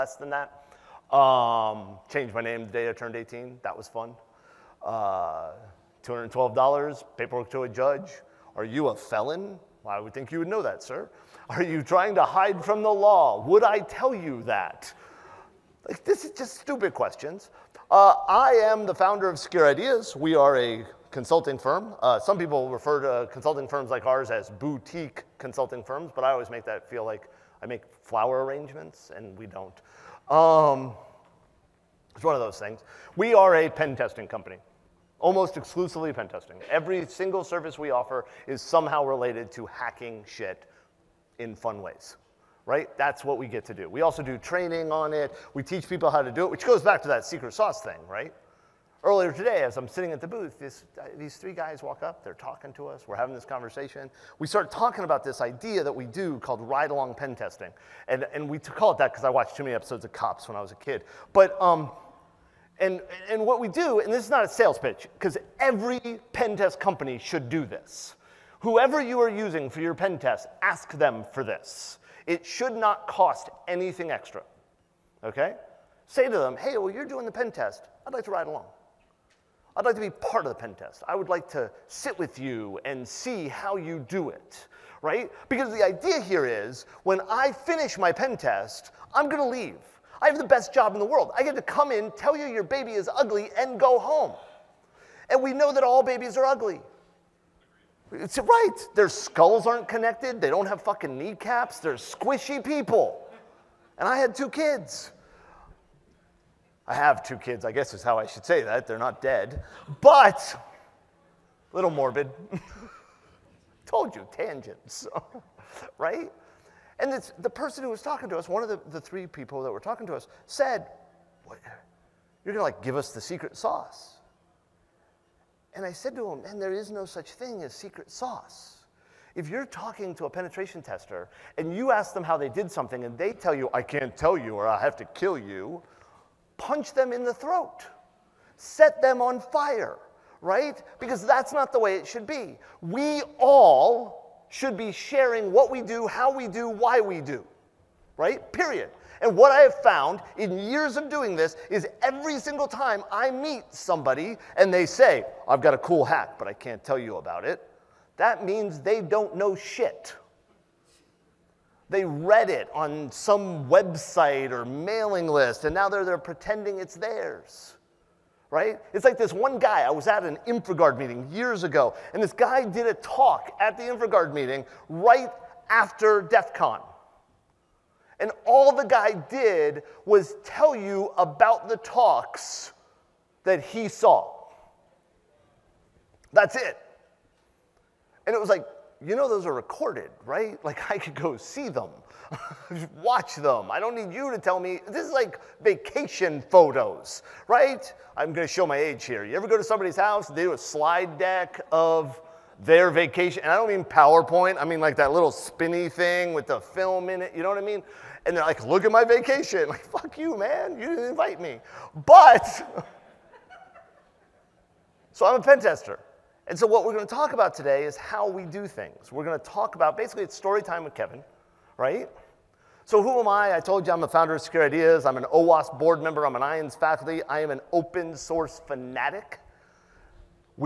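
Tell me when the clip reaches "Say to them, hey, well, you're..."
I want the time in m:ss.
1:16.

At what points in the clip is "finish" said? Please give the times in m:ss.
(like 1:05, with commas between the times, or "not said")
1:27.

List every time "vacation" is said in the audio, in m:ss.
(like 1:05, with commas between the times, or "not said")
3:15, 3:22, 3:29.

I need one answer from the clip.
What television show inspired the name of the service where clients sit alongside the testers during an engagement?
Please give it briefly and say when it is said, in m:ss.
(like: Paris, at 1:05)
Cops, at 1:00.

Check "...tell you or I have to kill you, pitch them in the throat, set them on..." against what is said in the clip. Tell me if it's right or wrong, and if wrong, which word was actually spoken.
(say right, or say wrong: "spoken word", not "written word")
wrong: "punch", not "pitch".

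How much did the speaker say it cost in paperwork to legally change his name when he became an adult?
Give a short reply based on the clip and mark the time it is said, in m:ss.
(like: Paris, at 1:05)
$212, at 0:06.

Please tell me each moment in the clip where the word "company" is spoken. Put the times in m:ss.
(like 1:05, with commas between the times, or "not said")
0:34, 1:06.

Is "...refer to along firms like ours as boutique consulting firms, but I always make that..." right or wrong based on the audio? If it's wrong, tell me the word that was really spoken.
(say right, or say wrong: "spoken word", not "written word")
wrong: "consulting", not "along".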